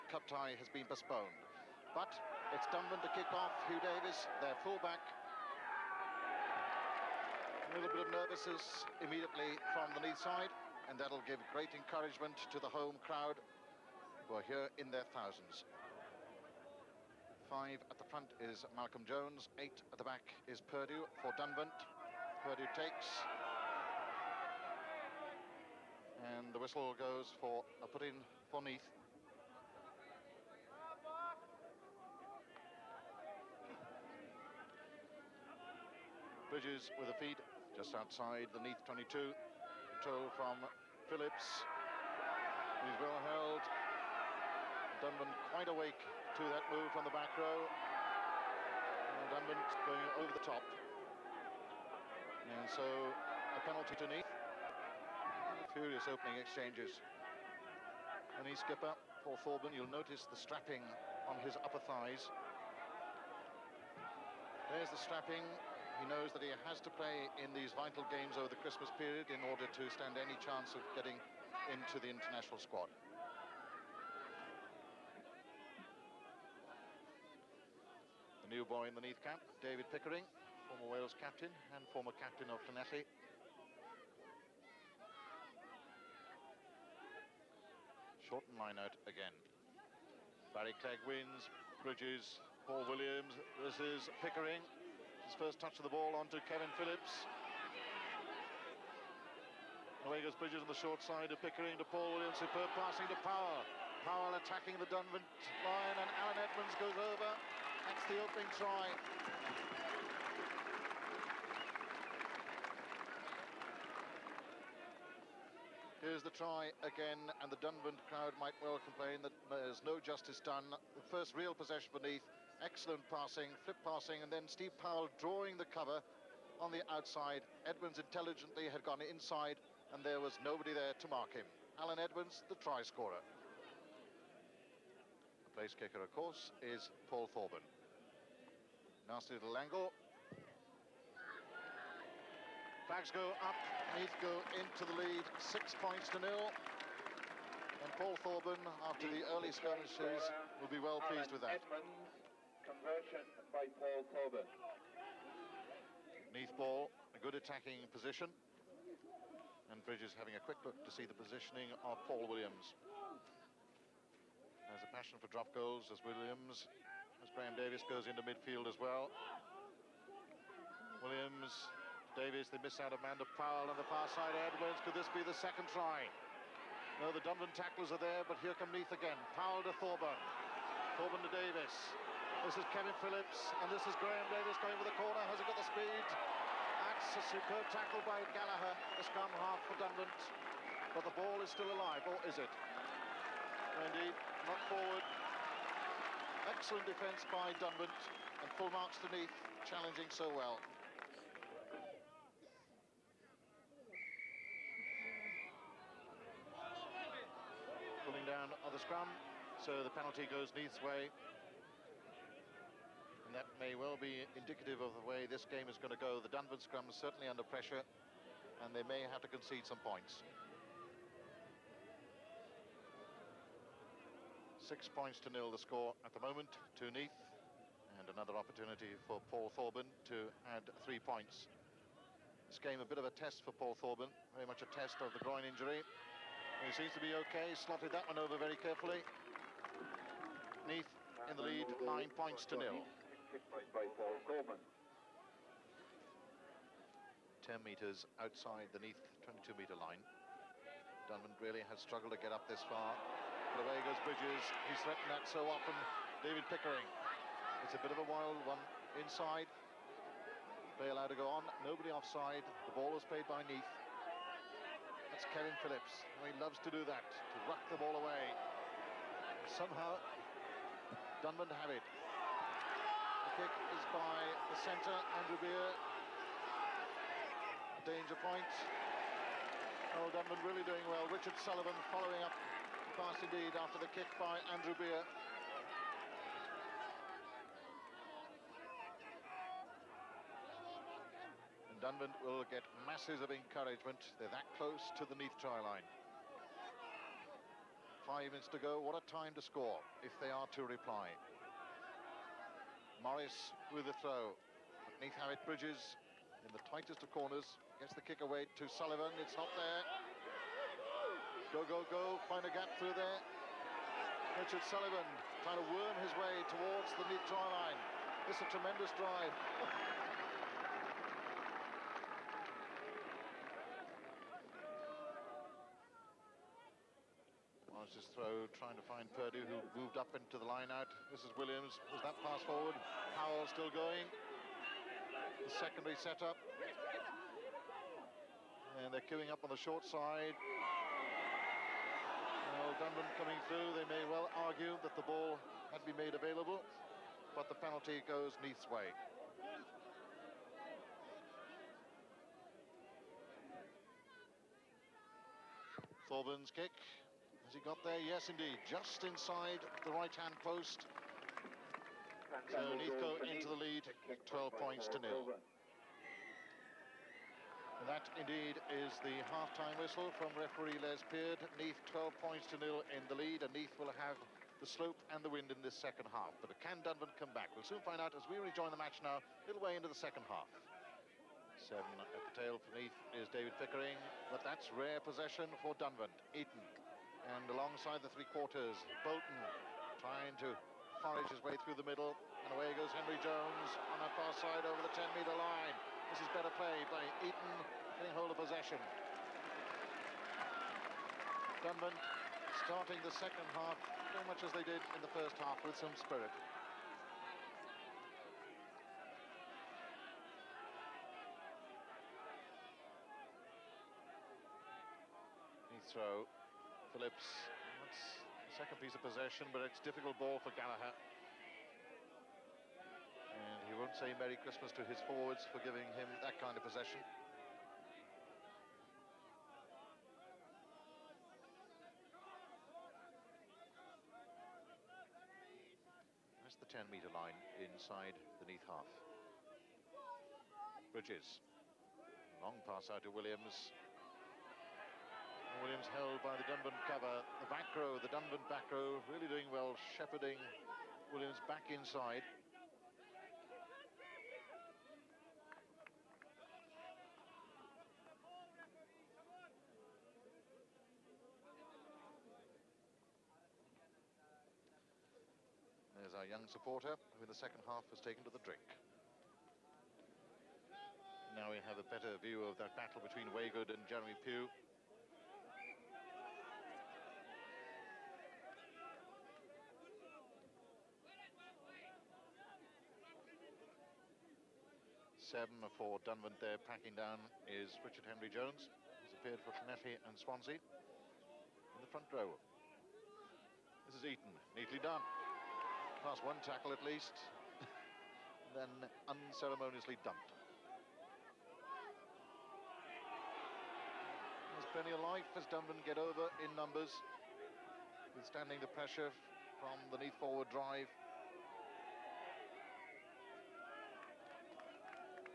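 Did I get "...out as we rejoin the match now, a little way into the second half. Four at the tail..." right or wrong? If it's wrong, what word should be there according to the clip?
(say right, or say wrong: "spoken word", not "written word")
wrong: "Seven", not "Four".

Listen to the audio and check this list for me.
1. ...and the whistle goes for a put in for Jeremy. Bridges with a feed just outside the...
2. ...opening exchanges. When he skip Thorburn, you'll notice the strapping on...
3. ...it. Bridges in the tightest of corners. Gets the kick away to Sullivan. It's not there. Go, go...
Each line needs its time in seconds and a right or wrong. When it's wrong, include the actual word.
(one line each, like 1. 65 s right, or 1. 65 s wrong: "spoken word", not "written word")
1. 26 s wrong: "Neath", not "Jeremy"
2. 56 s right
3. 305 s right.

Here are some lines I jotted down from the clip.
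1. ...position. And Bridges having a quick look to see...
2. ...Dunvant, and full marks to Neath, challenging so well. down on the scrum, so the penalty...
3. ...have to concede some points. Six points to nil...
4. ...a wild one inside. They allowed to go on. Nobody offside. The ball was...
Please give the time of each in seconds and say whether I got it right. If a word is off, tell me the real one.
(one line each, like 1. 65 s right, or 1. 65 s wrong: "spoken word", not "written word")
1. 157 s right
2. 197 s right
3. 219 s right
4. 257 s right.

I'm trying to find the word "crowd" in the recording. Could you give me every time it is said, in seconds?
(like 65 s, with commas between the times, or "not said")
12 s, 118 s.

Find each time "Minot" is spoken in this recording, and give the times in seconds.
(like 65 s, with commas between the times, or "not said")
88 s.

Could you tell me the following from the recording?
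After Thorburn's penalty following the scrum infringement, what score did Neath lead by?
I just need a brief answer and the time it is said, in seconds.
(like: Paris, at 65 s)
9-0, at 241 s.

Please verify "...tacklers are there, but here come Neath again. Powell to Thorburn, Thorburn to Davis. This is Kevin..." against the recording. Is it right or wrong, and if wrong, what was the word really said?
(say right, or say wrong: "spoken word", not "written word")
right.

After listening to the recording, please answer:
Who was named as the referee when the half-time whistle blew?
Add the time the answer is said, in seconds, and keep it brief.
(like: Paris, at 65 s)
Les Peard, at 370 s.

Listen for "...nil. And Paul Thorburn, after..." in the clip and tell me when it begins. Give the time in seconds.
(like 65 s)
146 s.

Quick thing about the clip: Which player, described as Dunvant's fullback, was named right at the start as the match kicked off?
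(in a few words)
Hugh Davis.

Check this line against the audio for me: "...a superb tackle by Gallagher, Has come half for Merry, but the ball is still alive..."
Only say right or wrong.
wrong.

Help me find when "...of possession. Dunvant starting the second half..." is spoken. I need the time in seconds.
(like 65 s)
398 s.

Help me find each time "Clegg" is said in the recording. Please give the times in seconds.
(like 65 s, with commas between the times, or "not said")
90 s.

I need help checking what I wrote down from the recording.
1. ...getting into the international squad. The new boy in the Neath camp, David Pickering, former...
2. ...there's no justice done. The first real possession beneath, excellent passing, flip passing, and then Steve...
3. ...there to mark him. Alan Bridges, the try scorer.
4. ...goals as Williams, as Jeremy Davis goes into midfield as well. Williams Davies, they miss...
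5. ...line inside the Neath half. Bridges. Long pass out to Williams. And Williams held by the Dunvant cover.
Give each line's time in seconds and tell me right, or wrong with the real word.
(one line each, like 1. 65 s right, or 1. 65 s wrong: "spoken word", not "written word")
1. 70 s right
2. 119 s right
3. 130 s wrong: "Edwards", not "Bridges"
4. 165 s wrong: "Graham", not "Jeremy"
5. 437 s right.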